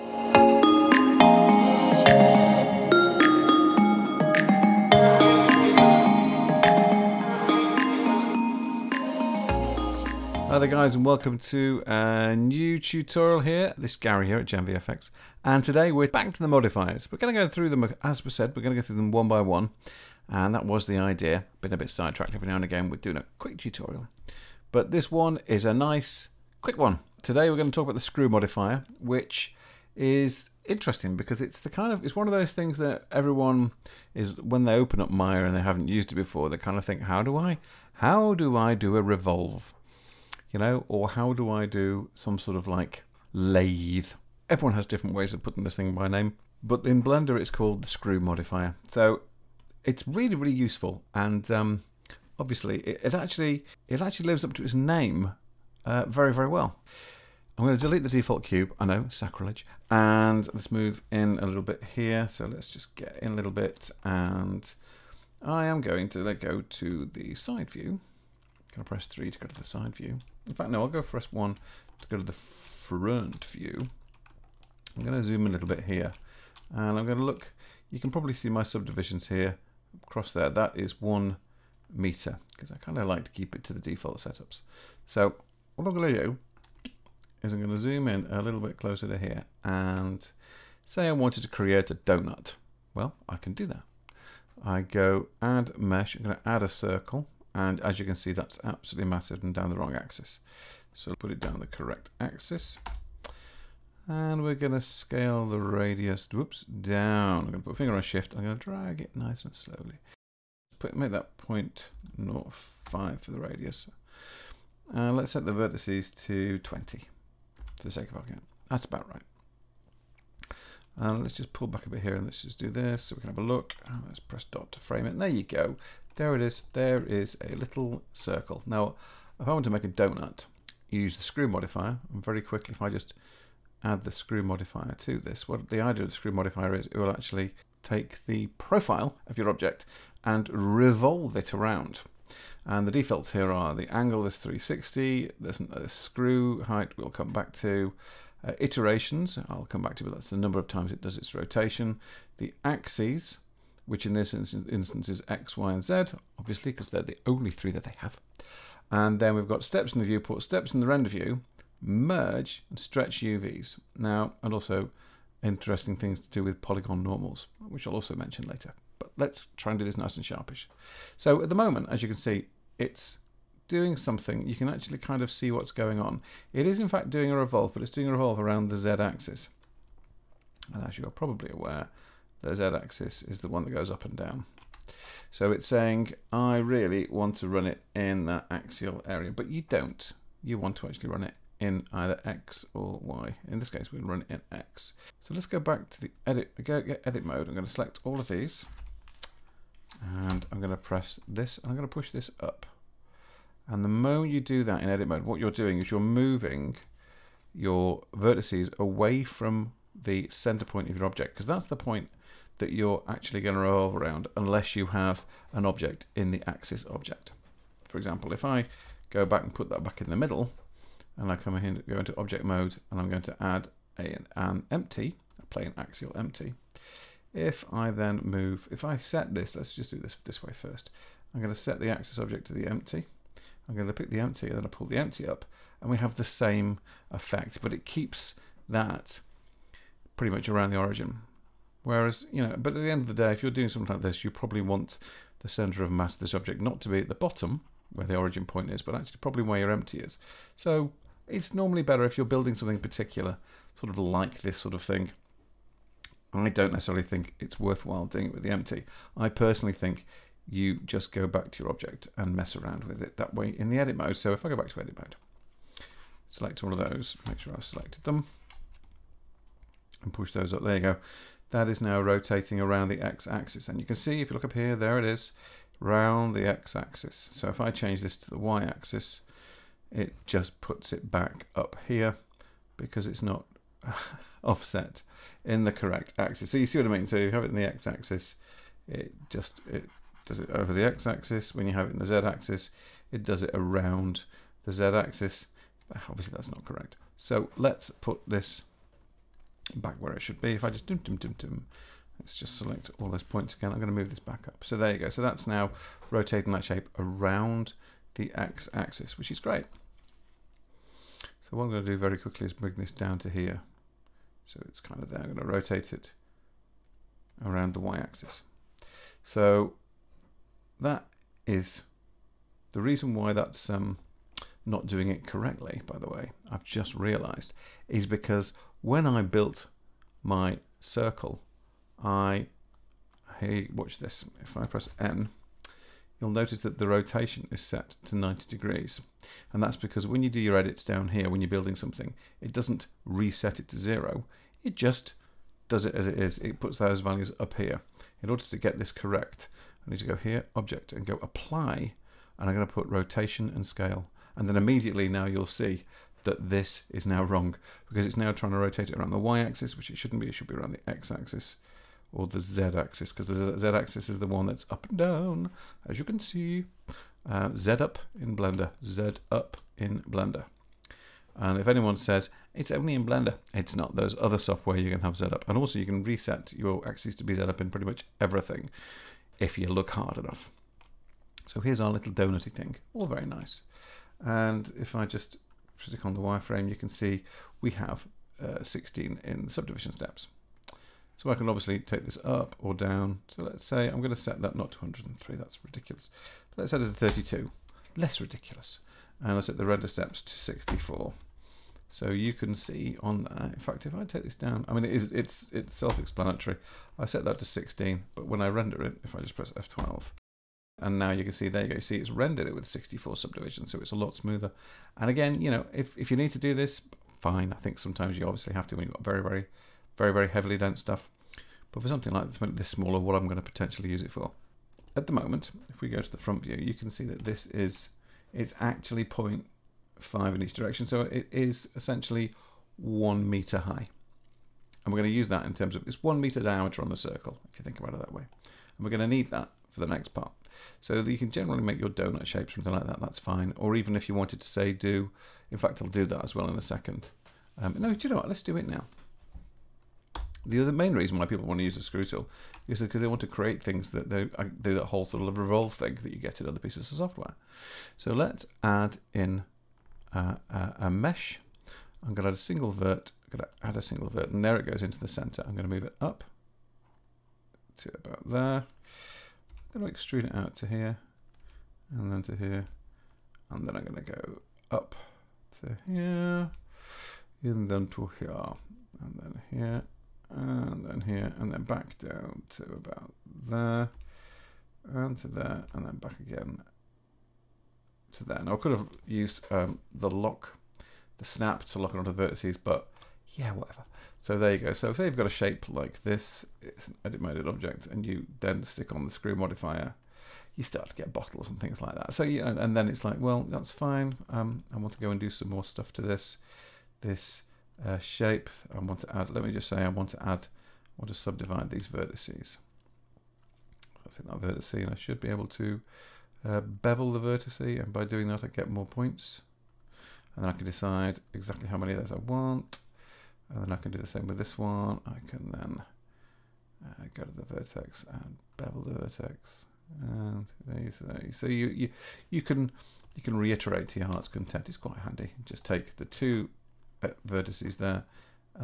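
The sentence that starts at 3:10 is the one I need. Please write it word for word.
You want to actually run it in either X or Y.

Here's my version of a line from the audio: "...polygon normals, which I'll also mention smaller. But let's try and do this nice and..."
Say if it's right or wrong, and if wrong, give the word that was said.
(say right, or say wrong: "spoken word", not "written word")
wrong: "later", not "smaller".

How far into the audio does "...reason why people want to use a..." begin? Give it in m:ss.
7:30.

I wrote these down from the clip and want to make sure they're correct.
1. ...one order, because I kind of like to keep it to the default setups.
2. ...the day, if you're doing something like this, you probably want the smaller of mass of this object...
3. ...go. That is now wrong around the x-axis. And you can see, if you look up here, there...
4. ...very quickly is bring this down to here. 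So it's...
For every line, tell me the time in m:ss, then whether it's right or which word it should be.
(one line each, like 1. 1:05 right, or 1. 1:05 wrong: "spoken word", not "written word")
1. 1:20 wrong: "meter", not "order"
2. 4:03 wrong: "center", not "smaller"
3. 4:30 wrong: "rotating", not "wrong"
4. 5:11 right.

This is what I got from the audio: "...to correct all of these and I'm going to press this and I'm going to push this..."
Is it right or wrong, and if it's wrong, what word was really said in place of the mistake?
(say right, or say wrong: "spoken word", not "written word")
wrong: "select", not "correct".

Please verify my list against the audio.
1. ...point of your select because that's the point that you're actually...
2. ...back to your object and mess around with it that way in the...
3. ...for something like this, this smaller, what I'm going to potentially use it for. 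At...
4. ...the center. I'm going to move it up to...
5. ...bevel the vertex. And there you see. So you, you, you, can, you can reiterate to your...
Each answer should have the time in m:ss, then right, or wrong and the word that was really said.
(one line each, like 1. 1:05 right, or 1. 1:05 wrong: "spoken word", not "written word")
1. 3:30 wrong: "object", not "select"
2. 4:21 right
3. 7:01 right
4. 7:44 right
5. 8:48 right.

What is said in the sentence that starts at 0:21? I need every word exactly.
Been a bit sidetracked every now and again, we're doing a quick tutorial.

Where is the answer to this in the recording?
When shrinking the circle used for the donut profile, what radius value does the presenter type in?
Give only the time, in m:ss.
1:51.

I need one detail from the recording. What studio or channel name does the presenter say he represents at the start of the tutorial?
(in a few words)
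Gen VFX.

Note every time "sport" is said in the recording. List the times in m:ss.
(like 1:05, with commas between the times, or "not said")
not said.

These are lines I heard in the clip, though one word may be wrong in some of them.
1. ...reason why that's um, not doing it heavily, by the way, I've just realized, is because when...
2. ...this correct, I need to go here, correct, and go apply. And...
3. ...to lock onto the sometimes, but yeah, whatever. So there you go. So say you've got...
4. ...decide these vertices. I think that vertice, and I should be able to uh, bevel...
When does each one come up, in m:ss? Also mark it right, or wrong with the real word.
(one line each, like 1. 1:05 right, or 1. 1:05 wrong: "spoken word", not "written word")
1. 5:22 wrong: "correctly", not "heavily"
2. 5:48 wrong: "object", not "correct"
3. 8:11 wrong: "vertices", not "sometimes"
4. 8:31 wrong: "subdivide", not "decide".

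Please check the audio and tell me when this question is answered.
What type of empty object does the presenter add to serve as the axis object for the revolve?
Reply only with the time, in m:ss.
3:45.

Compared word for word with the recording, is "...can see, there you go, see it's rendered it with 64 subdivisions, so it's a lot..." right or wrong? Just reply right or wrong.
right.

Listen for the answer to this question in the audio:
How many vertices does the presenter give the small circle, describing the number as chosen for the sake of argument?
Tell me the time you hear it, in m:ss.
1:56.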